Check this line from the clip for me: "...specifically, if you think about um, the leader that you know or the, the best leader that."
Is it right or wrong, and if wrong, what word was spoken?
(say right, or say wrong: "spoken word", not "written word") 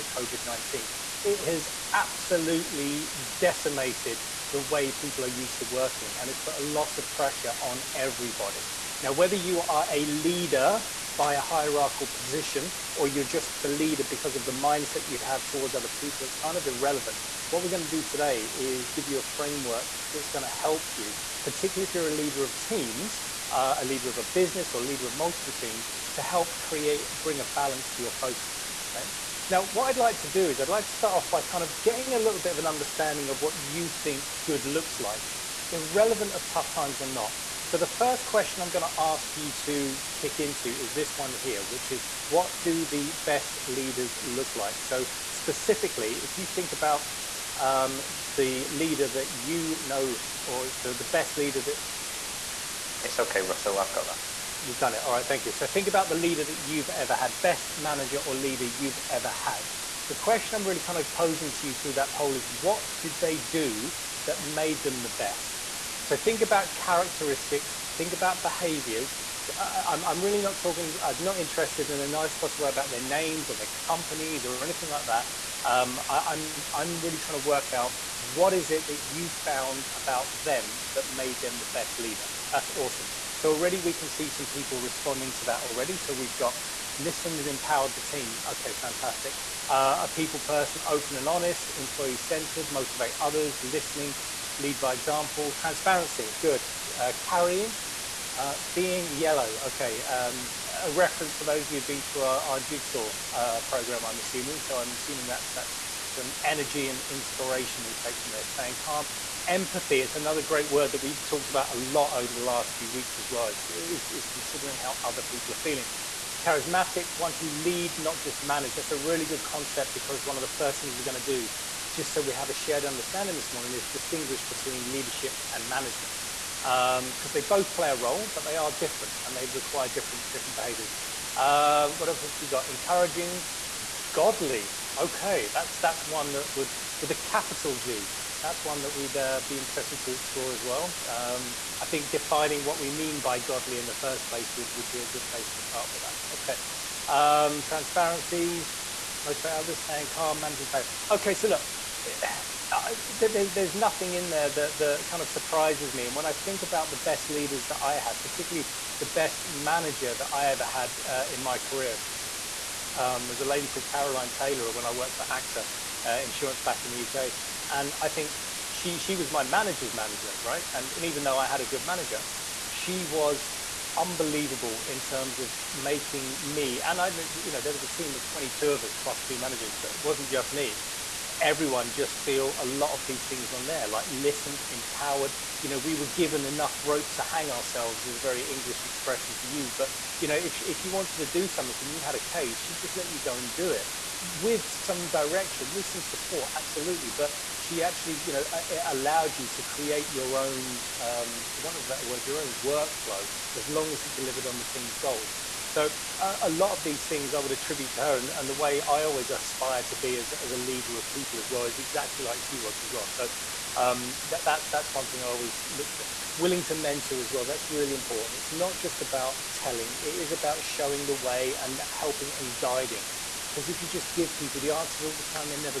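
right.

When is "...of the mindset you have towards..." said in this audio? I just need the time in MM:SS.
00:14.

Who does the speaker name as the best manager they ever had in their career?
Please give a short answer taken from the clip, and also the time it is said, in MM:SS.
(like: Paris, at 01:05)
Caroline Taylor, at 02:43.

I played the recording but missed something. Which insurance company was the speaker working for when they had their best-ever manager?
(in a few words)
AXA.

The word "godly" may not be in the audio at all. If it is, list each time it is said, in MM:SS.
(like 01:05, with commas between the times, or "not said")
02:14, 02:23.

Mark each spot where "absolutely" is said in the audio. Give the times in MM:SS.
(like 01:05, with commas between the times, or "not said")
00:01, 03:16.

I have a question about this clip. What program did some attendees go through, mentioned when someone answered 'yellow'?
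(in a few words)
jigsaw.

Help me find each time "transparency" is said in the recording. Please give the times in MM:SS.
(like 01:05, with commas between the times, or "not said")
01:35, 02:27.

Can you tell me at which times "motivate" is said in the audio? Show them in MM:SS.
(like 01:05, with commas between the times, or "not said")
01:32, 02:29.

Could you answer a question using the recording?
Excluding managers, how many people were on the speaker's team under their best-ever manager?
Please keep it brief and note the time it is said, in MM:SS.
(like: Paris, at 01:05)
22, at 02:58.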